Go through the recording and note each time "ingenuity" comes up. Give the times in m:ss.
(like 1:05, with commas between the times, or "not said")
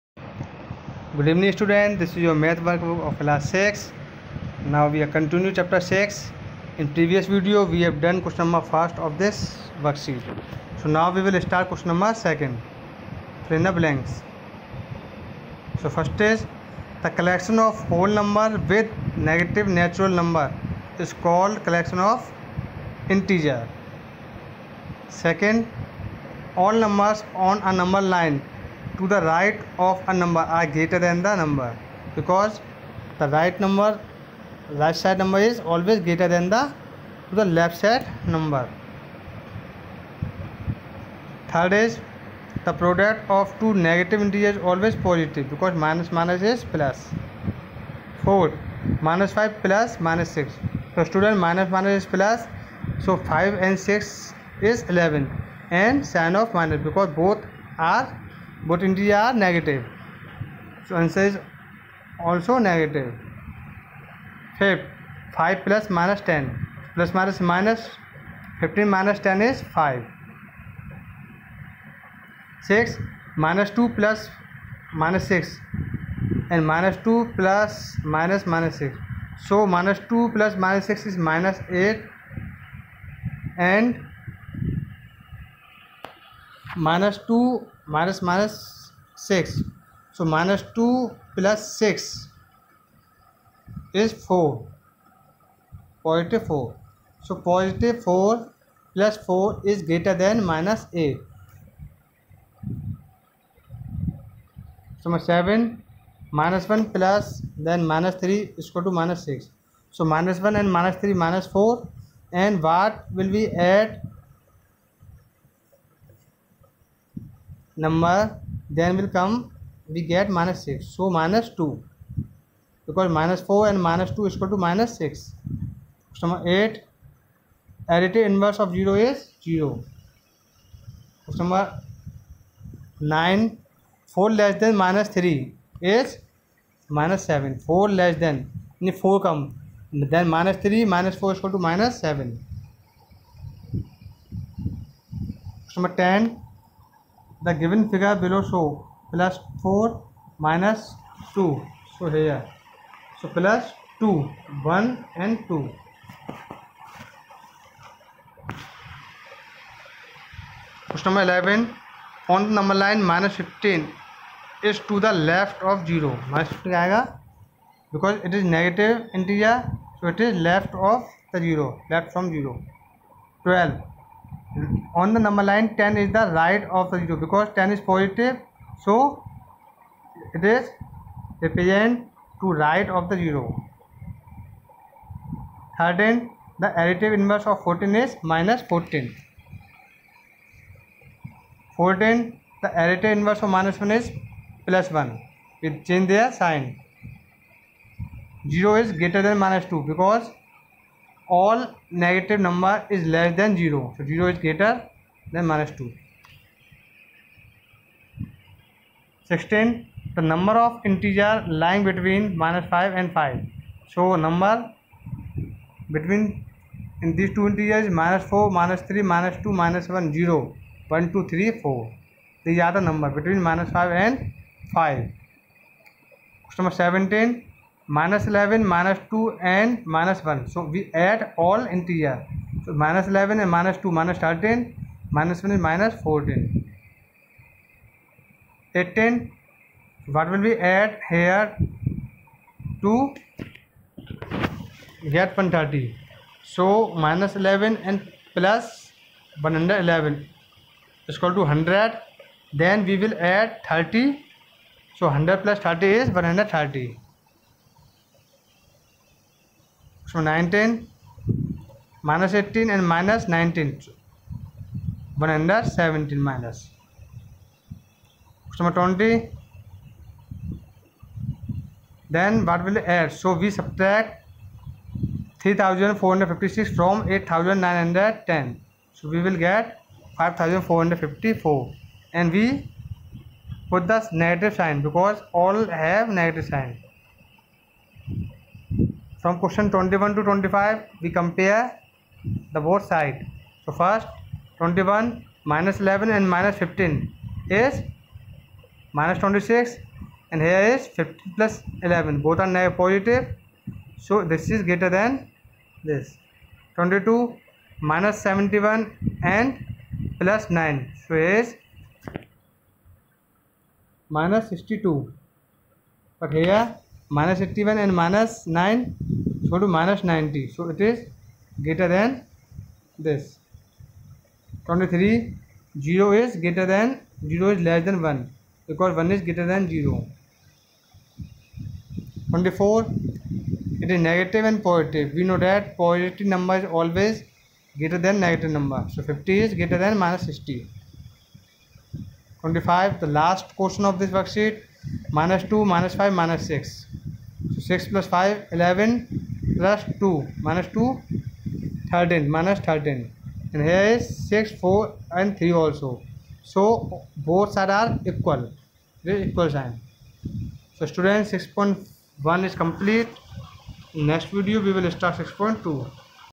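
not said.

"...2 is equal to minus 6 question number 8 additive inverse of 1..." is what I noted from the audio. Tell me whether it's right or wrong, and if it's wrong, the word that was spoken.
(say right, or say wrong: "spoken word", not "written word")
wrong: "0", not "1".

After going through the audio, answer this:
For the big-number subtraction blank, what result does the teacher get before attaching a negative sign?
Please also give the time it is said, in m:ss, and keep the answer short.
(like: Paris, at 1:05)
5454, at 4:40.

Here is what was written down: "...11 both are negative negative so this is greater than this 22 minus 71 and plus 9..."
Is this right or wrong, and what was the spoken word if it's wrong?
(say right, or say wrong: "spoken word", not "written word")
wrong: "positive", not "negative".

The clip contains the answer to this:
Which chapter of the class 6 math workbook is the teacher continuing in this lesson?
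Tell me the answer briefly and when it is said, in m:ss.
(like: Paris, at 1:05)
Chapter 6, at 0:05.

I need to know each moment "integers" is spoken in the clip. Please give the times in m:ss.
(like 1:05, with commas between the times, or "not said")
0:23, 0:44, 0:58, 3:30, 3:37.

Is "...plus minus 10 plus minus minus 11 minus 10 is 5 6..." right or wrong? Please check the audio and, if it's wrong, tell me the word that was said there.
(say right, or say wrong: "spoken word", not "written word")
wrong: "15", not "11".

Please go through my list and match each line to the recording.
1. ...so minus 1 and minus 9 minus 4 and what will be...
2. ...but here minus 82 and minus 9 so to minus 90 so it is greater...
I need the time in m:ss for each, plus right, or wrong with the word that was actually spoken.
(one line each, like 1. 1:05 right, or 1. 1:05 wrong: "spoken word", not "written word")
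1. 1:49 wrong: "3", not "9"
2. 5:16 wrong: "81", not "82".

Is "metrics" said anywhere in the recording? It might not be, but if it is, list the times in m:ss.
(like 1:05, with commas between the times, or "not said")
not said.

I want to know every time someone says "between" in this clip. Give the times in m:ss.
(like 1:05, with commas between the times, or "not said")
3:31, 3:35, 3:43.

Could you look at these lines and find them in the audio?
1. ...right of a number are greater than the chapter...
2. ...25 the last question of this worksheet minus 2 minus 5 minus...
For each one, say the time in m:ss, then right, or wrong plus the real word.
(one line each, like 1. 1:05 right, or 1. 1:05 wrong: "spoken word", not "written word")
1. 0:29 wrong: "number", not "chapter"
2. 5:41 right.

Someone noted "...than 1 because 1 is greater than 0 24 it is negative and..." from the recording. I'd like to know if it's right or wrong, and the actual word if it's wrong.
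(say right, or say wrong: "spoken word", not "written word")
right.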